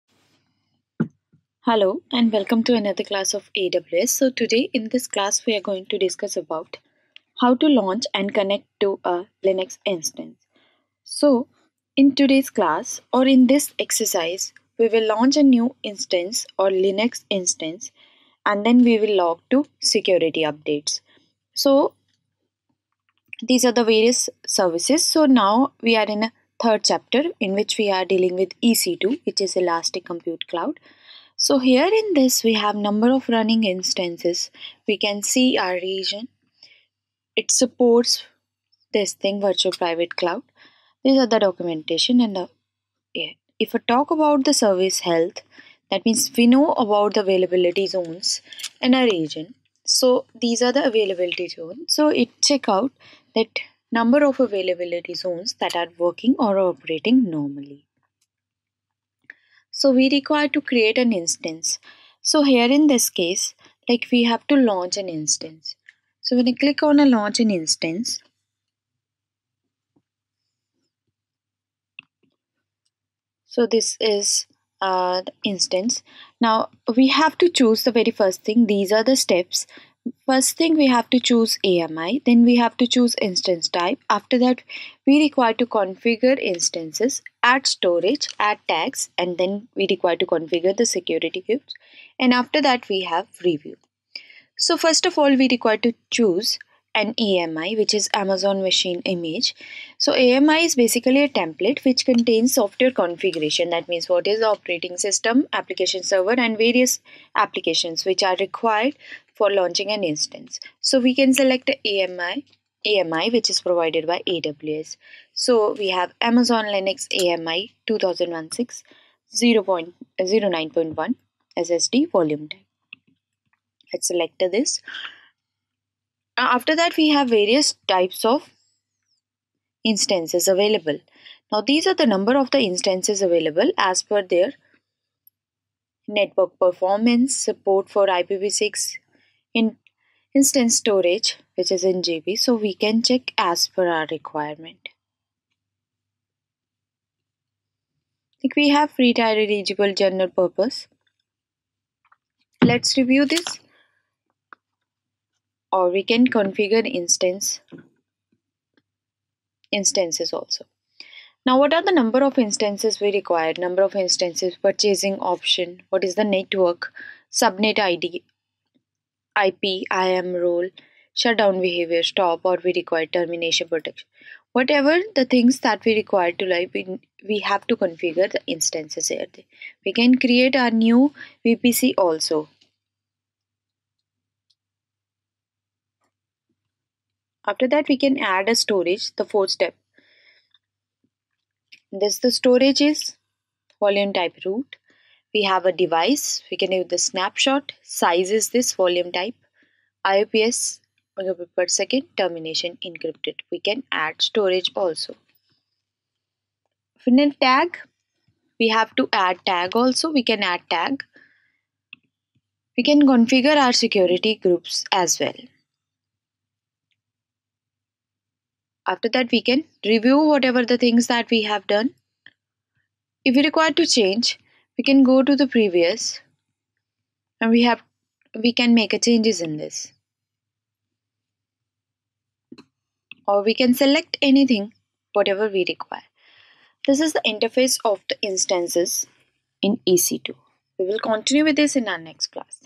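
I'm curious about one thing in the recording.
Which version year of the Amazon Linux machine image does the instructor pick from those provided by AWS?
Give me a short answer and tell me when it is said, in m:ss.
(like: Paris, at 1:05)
2016, at 1:57.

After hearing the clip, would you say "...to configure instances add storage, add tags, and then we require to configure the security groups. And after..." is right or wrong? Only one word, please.
right.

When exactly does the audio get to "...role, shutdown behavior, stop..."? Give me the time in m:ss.
2:50.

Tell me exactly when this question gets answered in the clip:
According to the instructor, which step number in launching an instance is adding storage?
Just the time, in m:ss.
3:09.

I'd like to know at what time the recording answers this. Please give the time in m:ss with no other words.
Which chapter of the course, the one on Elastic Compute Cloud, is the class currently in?
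0:26.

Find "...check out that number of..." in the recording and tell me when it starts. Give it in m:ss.
0:52.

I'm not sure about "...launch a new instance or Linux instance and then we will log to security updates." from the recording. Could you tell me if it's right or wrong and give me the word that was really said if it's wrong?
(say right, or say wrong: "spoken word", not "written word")
right.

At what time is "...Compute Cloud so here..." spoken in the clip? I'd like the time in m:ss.
0:30.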